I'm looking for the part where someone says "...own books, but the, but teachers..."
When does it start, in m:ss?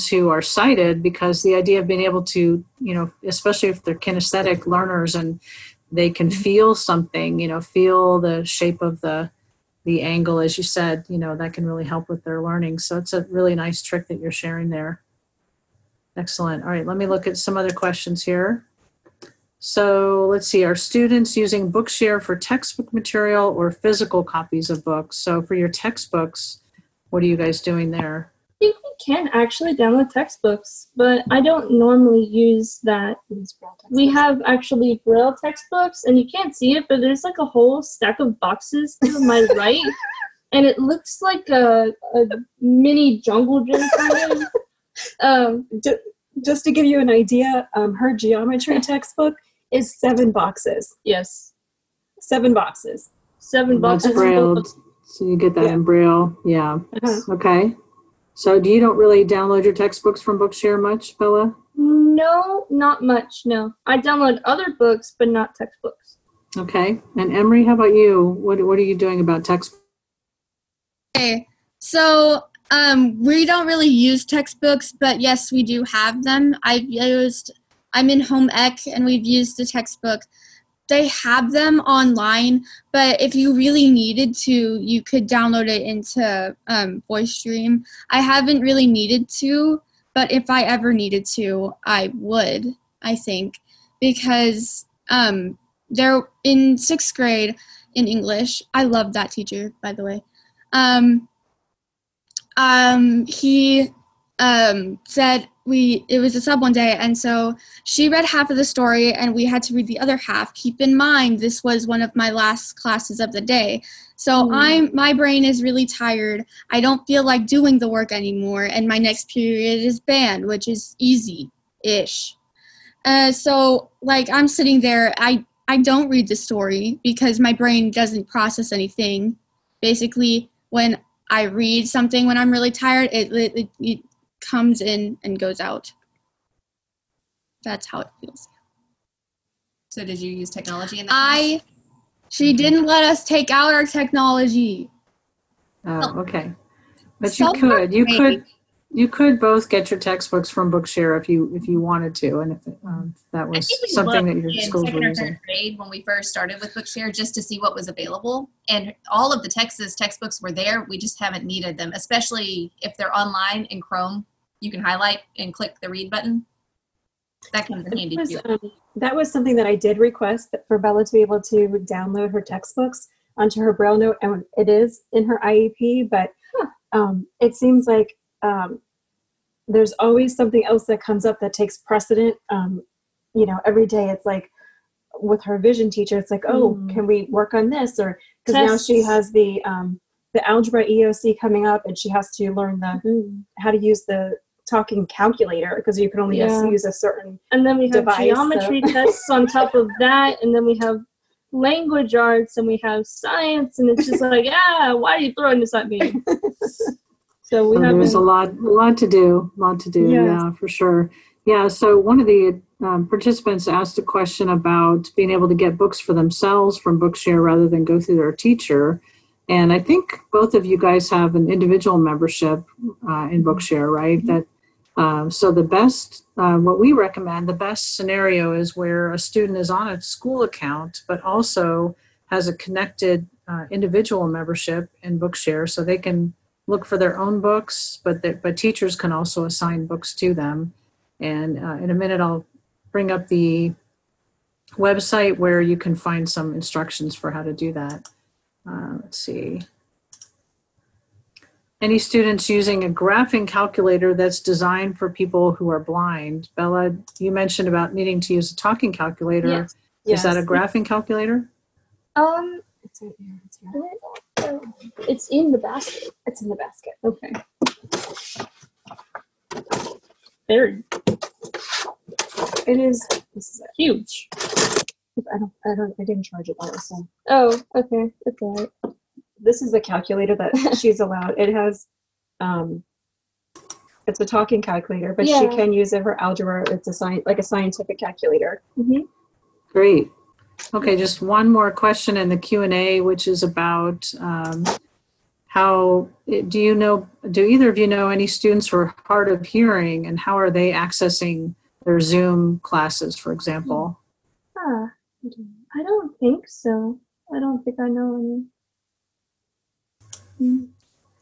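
3:57.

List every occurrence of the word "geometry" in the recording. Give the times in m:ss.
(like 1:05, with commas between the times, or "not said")
0:48, 3:18.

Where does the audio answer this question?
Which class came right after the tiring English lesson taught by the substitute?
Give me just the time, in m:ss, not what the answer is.
1:59.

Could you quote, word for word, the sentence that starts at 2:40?
We just haven't needed them, especially if they're online in Chrome.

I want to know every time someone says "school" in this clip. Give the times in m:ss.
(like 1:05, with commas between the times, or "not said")
2:34, 3:50.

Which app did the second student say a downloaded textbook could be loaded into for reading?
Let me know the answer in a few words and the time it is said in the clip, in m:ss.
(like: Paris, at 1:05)
Voice Dream, at 1:27.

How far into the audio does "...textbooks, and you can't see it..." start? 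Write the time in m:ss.
0:35.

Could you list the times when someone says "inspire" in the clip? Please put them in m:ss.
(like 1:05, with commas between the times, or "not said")
not said.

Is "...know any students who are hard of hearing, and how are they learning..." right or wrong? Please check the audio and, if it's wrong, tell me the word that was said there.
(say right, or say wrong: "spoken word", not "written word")
wrong: "accessing", not "learning".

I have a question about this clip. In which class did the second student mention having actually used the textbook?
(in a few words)
Home ec.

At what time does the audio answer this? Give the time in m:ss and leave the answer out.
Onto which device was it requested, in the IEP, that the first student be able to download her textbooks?
2:53.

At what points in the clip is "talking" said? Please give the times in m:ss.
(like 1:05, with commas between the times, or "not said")
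3:14, 4:18, 4:44.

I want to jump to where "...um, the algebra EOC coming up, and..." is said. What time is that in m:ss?
3:09.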